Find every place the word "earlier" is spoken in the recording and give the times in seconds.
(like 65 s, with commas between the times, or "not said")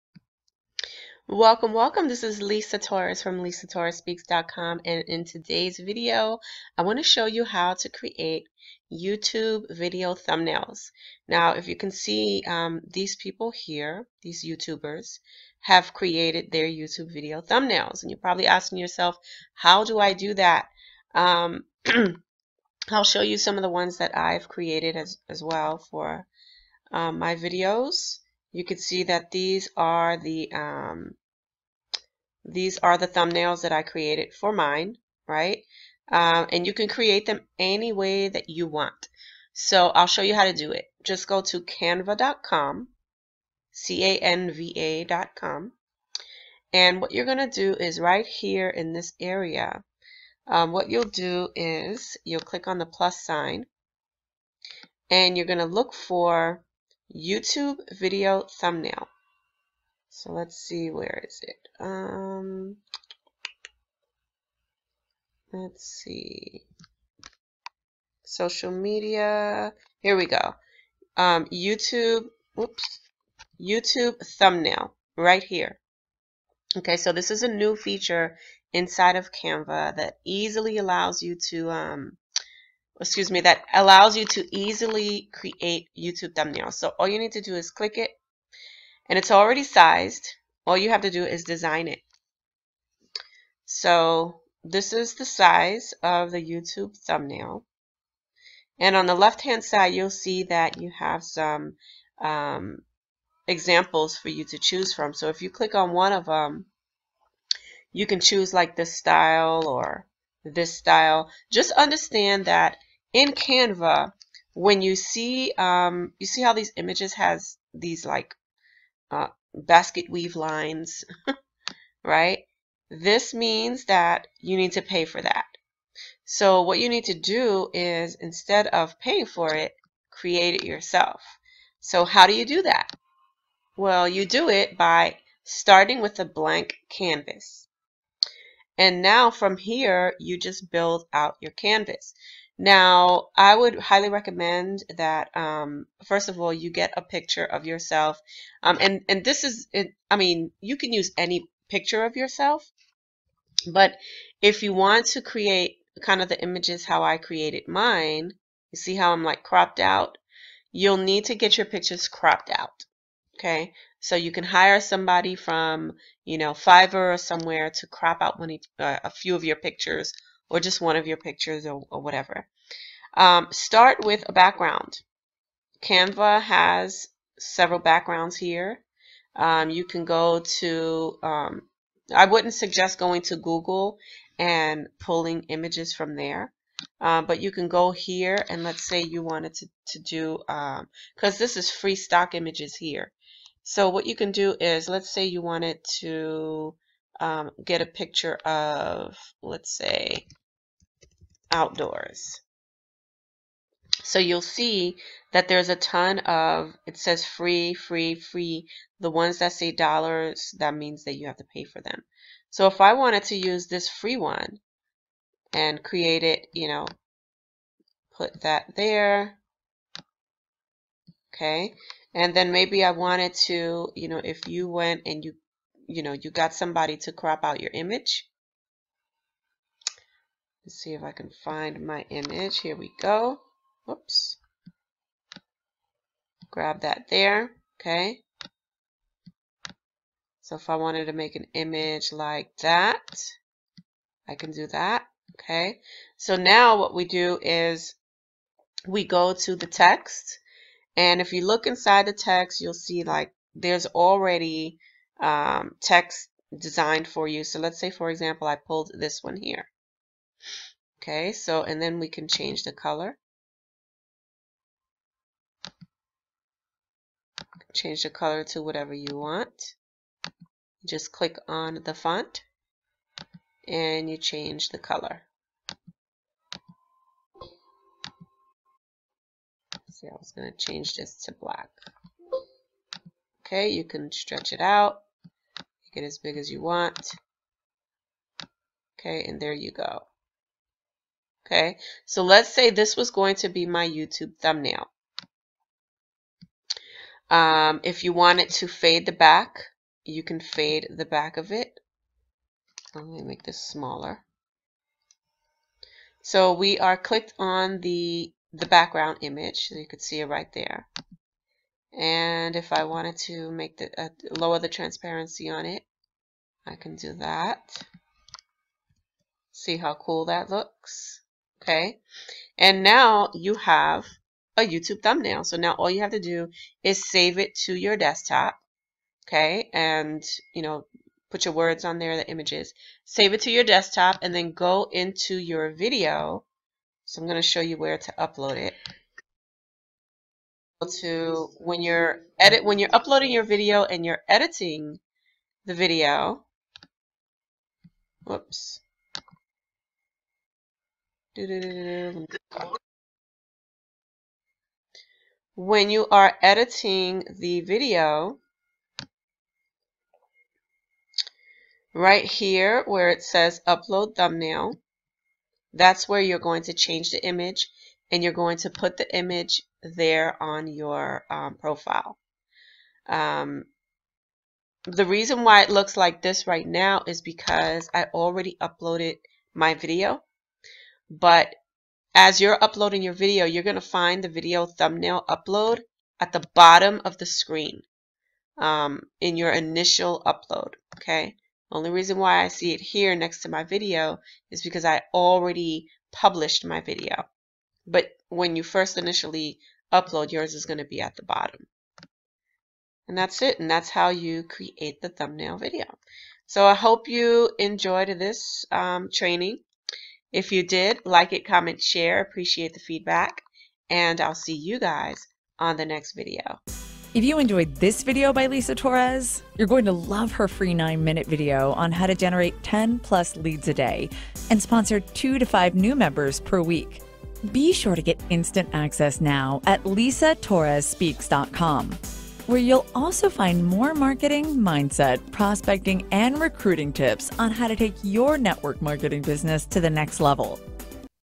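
not said.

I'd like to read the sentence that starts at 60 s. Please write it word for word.
So let's see, where is it?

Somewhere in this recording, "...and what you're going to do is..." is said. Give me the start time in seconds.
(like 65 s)
46 s.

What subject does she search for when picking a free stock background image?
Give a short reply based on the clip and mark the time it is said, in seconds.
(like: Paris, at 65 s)
outdoors, at 201 s.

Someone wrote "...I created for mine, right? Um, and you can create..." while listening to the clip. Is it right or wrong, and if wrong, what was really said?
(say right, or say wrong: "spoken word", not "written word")
right.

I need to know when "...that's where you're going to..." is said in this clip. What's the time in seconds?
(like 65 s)
365 s.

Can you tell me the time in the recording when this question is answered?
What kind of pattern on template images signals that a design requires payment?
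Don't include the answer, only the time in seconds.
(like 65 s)
119 s.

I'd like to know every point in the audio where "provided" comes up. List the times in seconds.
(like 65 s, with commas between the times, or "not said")
not said.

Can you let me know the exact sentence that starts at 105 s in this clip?
So if you click on one of them, you can choose like this style or this style.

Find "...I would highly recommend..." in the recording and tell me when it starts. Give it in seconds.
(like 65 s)
143 s.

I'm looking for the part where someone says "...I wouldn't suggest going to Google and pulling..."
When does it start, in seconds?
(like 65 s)
182 s.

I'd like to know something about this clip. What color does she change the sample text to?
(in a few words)
black.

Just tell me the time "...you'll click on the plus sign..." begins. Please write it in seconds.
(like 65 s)
52 s.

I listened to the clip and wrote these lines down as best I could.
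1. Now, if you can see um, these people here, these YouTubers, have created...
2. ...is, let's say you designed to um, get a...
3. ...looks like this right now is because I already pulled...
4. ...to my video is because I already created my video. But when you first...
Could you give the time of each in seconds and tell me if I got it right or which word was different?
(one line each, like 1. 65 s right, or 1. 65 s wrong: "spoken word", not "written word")
1. 11 s right
2. 194 s wrong: "wanted", not "designed"
3. 375 s wrong: "uploaded", not "pulled"
4. 393 s wrong: "published", not "created".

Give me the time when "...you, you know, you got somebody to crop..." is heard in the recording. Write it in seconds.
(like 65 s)
225 s.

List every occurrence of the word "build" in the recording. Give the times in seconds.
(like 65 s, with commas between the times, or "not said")
140 s.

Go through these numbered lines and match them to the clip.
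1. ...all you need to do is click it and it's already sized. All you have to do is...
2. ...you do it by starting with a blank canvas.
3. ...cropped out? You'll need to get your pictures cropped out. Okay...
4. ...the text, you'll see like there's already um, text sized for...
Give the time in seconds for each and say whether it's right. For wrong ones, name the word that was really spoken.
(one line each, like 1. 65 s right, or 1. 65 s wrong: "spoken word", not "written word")
1. 86 s right
2. 134 s right
3. 159 s right
4. 252 s wrong: "designed", not "sized".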